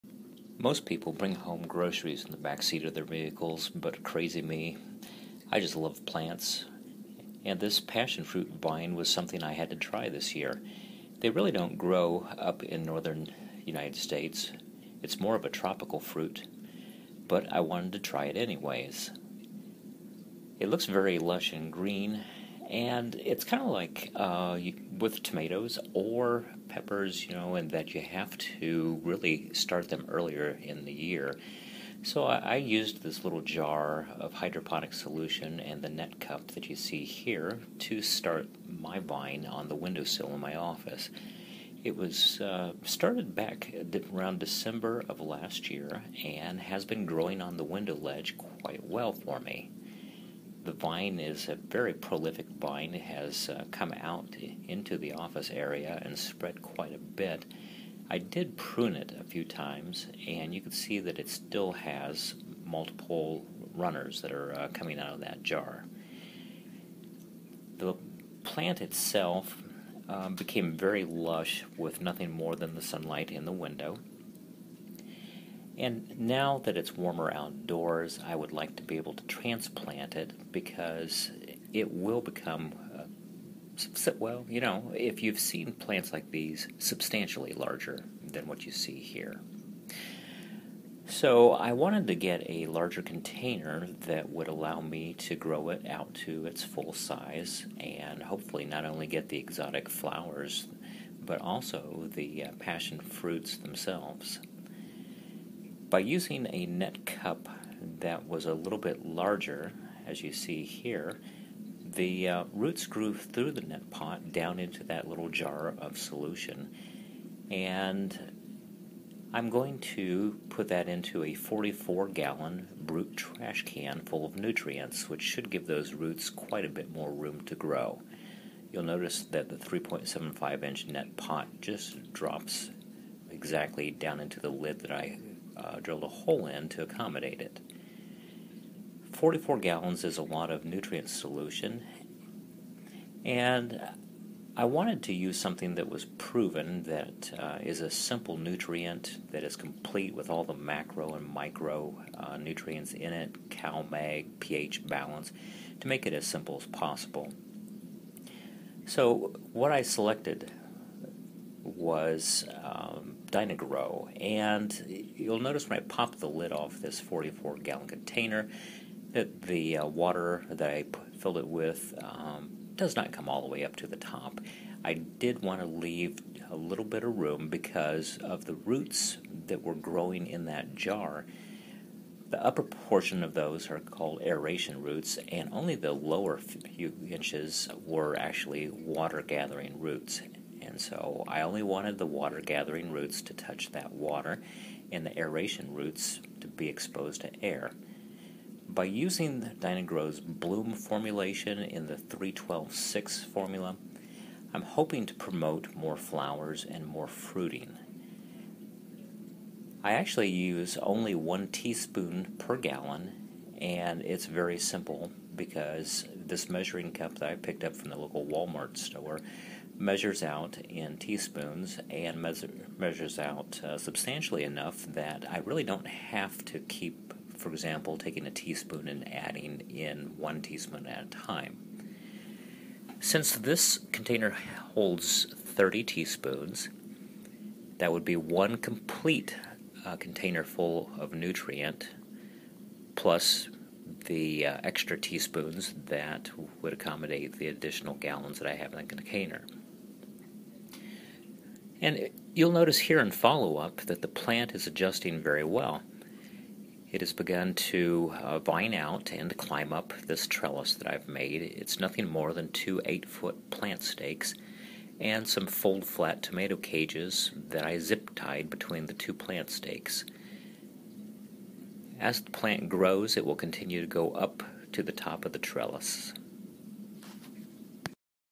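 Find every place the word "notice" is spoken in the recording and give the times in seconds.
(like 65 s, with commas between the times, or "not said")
128 s, 165 s, 252 s.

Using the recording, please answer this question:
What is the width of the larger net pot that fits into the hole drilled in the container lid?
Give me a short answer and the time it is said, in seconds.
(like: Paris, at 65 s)
3.75 inch, at 129 s.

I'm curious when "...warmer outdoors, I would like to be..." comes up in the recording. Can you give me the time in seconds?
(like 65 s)
76 s.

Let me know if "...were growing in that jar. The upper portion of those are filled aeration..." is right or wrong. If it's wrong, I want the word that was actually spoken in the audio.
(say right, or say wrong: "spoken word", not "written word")
wrong: "called", not "filled".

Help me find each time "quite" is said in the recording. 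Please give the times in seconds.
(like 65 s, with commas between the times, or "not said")
48 s, 56 s, 126 s.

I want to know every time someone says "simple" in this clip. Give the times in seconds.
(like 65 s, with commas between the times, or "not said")
147 s, 156 s, 214 s.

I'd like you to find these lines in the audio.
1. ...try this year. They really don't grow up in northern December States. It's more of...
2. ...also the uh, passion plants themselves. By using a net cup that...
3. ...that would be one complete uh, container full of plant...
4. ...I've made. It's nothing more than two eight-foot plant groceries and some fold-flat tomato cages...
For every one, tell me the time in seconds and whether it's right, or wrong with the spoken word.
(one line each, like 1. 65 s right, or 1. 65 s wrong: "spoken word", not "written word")
1. 9 s wrong: "United", not "December"
2. 101 s wrong: "fruits", not "plants"
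3. 237 s wrong: "nutrient", not "plant"
4. 260 s wrong: "stakes", not "groceries".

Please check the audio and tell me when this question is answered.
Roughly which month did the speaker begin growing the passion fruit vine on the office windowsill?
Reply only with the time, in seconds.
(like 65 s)
44 s.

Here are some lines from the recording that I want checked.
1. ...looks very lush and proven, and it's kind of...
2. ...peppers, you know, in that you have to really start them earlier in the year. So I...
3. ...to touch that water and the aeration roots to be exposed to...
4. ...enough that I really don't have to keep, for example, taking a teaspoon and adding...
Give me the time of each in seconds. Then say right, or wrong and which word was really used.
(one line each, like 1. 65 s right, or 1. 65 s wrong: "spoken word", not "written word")
1. 20 s wrong: "green", not "proven"
2. 26 s right
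3. 193 s right
4. 224 s right.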